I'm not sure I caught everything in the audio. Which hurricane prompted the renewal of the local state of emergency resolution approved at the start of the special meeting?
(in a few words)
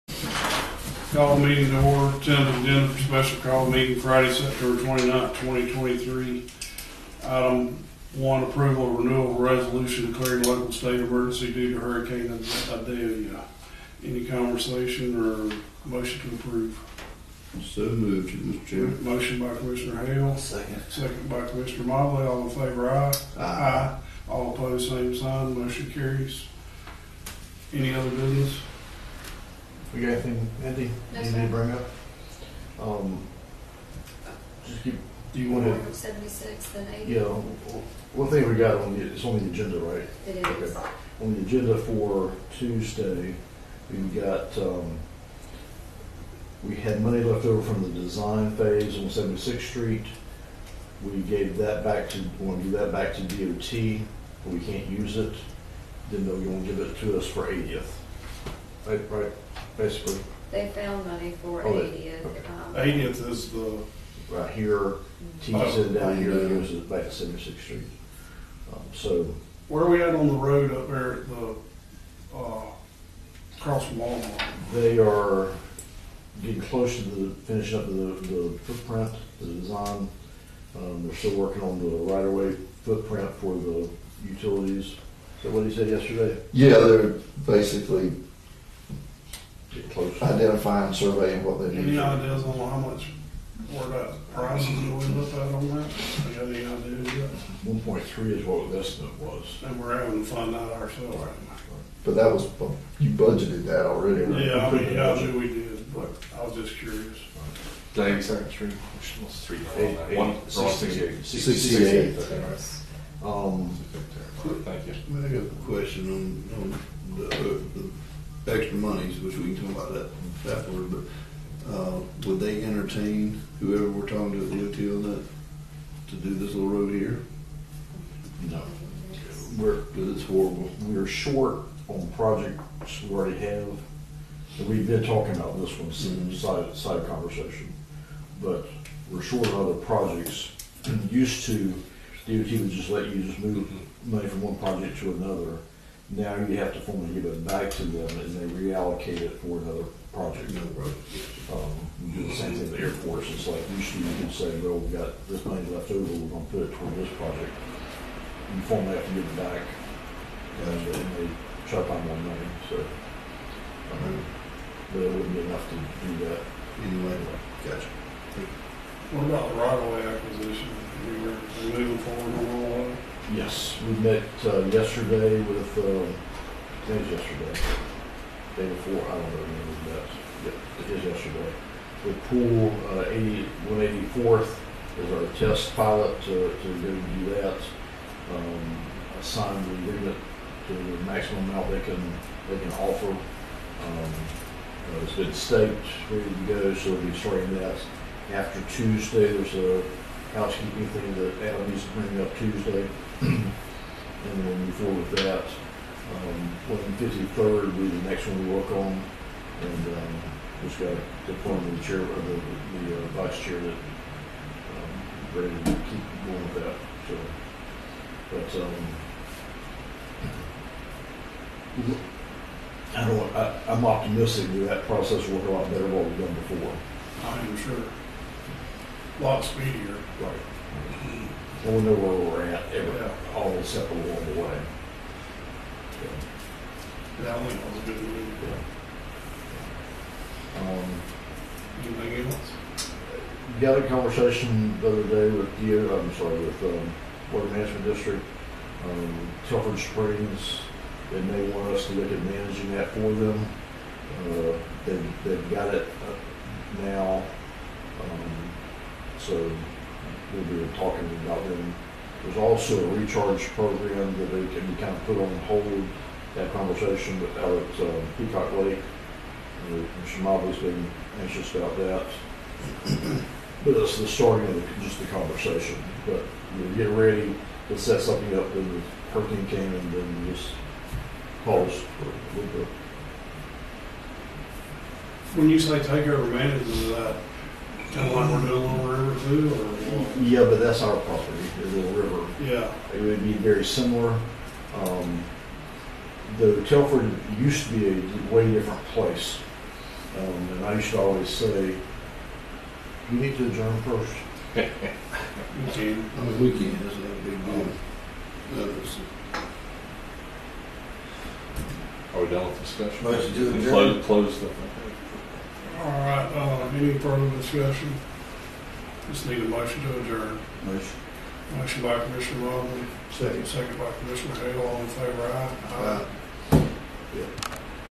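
Idalia.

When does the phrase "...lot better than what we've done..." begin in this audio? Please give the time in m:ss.
3:45.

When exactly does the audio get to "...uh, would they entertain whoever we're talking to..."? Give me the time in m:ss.
2:01.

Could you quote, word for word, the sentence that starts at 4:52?
Yeah, It would be very similar.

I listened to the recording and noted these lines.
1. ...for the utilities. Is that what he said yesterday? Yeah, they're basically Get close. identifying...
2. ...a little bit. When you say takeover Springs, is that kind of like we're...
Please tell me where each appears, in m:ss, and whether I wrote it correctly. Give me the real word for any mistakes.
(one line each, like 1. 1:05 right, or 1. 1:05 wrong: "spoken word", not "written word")
1. 1:23 right
2. 4:42 wrong: "Management", not "Springs".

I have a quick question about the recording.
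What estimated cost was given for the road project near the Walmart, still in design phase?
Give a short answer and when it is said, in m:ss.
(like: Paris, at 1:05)
1.3, at 1:37.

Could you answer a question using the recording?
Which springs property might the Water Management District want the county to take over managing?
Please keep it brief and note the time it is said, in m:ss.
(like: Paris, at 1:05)
Telford Springs, at 4:09.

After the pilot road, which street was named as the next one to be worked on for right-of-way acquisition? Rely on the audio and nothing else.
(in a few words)
153rd.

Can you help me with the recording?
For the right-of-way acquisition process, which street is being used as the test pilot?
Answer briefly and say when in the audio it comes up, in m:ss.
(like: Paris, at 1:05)
184th, at 3:03.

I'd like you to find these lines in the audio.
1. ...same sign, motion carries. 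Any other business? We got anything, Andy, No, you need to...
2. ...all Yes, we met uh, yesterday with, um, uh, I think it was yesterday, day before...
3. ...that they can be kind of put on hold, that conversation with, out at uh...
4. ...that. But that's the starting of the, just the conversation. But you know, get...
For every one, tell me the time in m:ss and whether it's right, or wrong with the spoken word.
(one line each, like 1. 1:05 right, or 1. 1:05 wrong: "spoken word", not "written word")
1. 0:24 right
2. 2:52 right
3. 4:24 right
4. 4:31 right.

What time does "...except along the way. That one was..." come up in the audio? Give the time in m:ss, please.
3:53.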